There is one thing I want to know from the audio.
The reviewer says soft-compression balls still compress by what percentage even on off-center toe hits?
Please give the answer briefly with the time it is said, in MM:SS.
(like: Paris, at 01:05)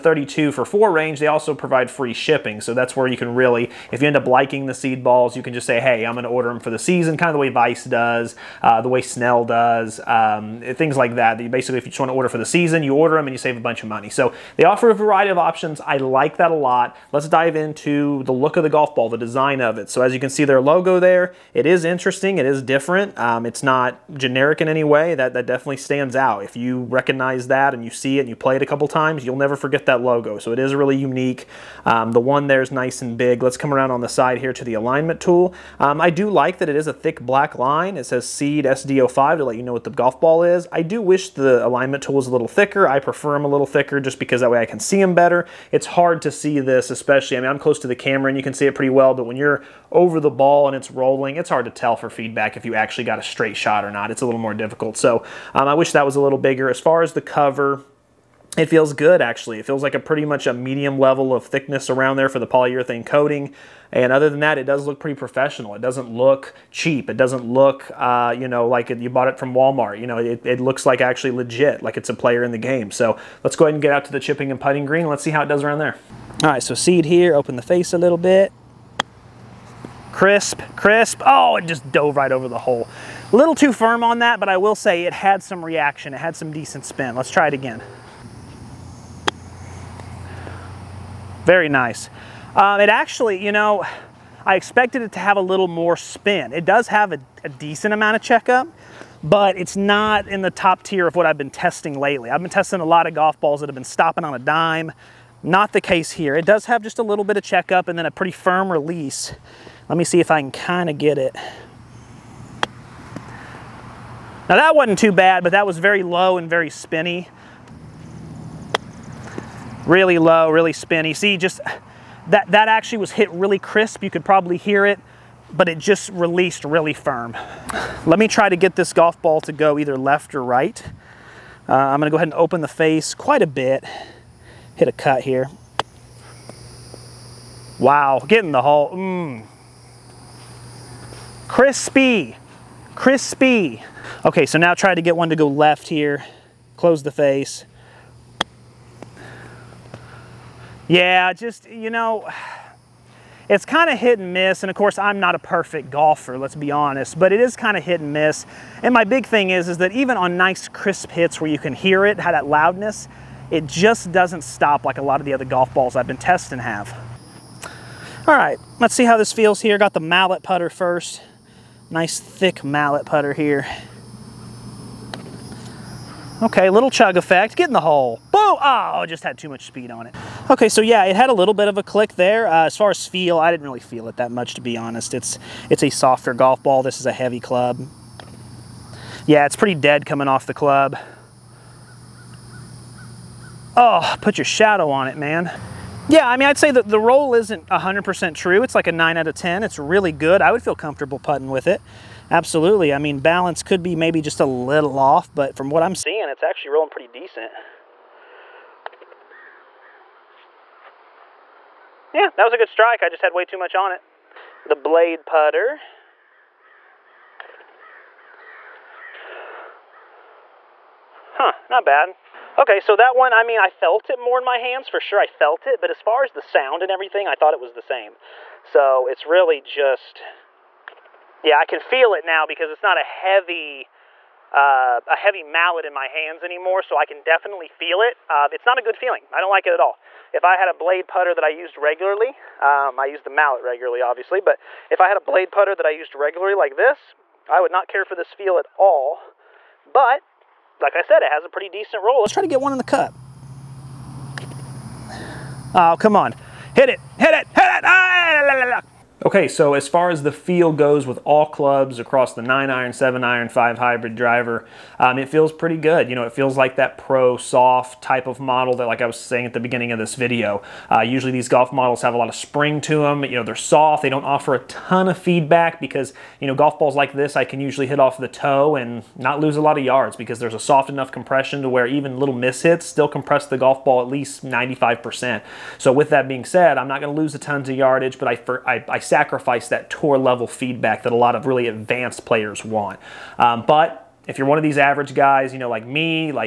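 95%, at 04:44.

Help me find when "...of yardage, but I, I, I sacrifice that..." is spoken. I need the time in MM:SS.
04:47.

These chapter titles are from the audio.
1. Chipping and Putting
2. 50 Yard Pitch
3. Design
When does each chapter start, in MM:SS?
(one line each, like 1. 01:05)
1. 01:15
2. 04:23
3. 00:16.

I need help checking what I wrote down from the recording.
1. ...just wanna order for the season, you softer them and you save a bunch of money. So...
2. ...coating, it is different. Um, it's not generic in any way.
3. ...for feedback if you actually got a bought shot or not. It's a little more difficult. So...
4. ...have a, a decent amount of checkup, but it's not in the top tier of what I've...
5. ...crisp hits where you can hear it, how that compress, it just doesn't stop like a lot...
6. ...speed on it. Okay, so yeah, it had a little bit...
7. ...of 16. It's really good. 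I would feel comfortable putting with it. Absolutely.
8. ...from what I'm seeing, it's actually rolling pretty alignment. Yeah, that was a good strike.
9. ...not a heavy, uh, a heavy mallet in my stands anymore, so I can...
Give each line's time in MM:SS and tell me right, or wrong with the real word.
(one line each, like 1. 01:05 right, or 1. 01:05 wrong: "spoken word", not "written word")
1. 00:11 wrong: "order", not "softer"
2. 00:21 wrong: "interesting", not "coating"
3. 00:51 wrong: "straight", not "bought"
4. 01:36 right
5. 02:40 wrong: "loudness", not "compress"
6. 02:59 right
7. 03:19 wrong: "10", not "16"
8. 03:25 wrong: "decent", not "alignment"
9. 03:52 wrong: "hands", not "stands".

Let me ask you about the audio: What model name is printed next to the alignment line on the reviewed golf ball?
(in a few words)
Seed SD05.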